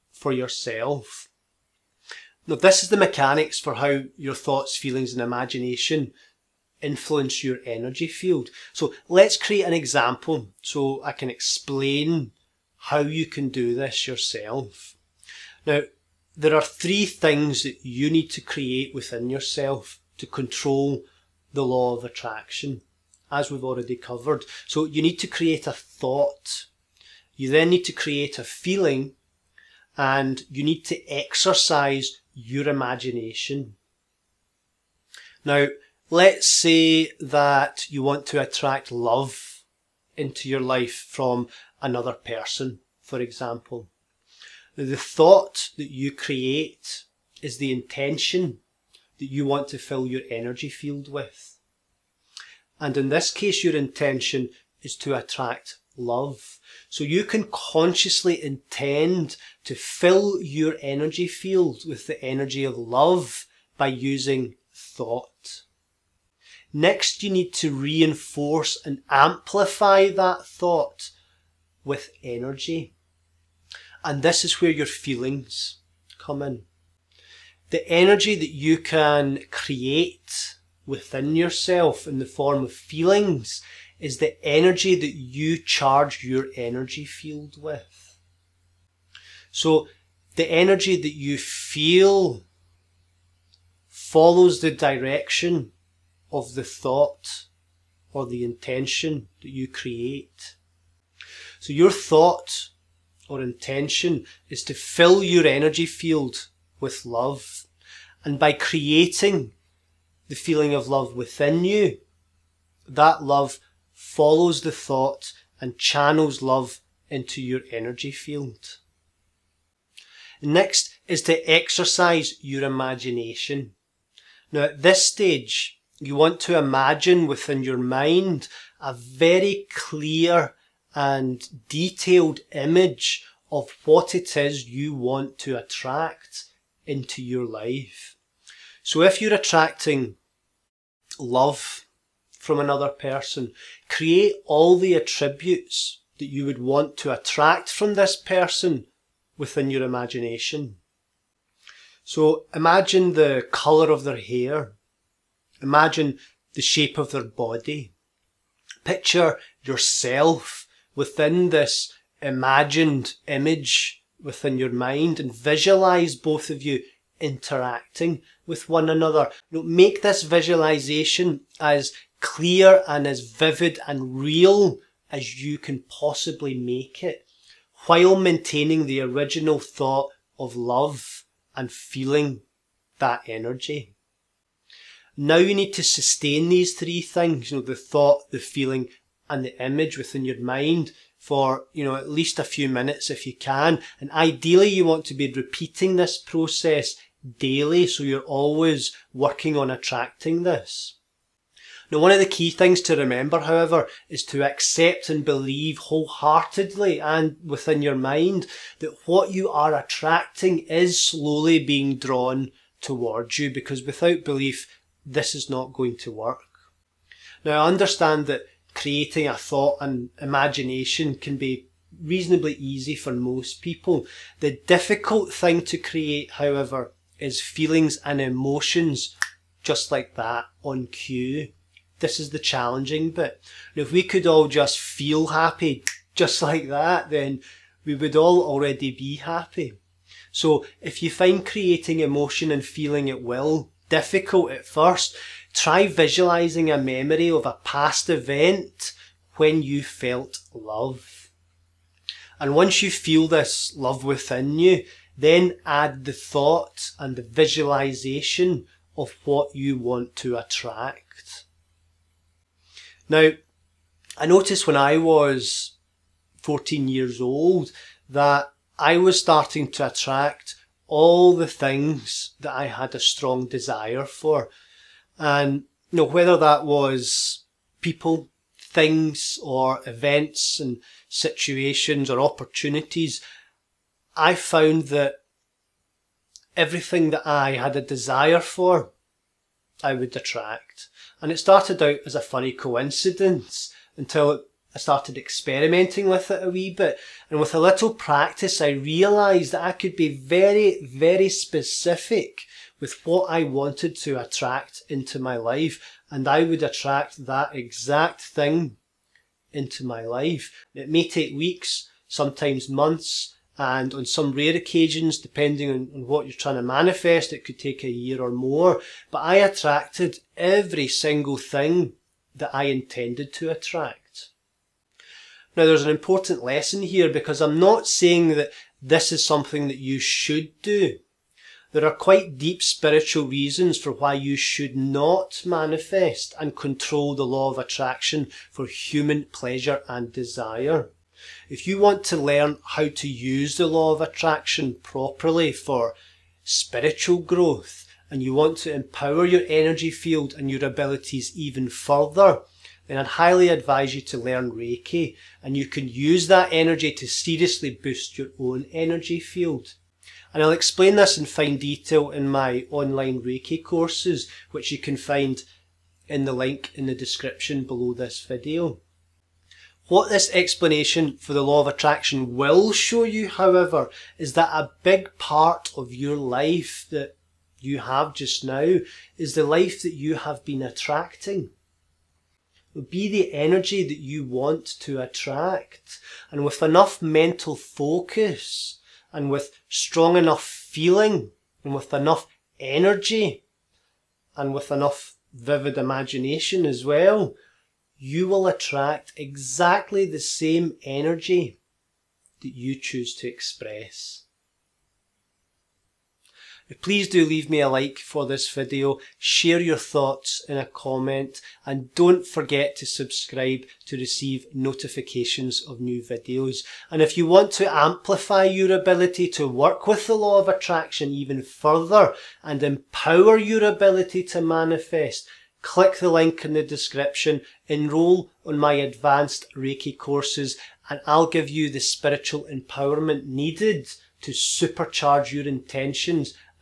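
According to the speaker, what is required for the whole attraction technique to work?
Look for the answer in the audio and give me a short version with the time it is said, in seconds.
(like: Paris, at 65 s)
belief, at 214 s.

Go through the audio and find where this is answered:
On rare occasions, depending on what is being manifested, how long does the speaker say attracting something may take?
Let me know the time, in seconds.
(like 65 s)
317 s.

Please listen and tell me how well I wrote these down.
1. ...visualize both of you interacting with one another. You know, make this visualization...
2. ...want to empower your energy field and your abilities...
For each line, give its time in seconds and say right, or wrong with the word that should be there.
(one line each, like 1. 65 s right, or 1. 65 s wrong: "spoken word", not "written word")
1. 165 s right
2. 348 s right.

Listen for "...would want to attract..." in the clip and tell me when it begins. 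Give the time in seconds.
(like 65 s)
146 s.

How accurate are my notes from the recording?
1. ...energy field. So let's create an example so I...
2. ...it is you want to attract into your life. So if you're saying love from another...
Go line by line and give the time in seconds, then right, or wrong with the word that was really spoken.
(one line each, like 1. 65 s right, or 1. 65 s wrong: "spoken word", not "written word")
1. 7 s right
2. 134 s wrong: "attracting", not "saying".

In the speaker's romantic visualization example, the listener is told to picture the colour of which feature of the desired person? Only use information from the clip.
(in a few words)
hair.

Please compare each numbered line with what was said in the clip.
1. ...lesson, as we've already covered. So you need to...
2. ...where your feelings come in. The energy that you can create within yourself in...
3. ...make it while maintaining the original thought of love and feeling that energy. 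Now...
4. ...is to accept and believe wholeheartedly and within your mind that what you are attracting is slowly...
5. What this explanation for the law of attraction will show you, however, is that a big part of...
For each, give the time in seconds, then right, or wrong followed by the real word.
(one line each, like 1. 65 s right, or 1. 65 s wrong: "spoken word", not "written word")
1. 22 s wrong: "attraction", not "lesson"
2. 74 s right
3. 176 s right
4. 204 s right
5. 369 s right.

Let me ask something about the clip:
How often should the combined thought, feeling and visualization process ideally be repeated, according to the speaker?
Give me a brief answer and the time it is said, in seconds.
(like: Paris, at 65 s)
daily, at 197 s.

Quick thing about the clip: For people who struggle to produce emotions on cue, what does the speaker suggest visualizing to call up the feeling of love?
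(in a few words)
a memory of a past event.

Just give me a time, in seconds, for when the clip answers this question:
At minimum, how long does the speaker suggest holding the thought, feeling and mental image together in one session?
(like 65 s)
192 s.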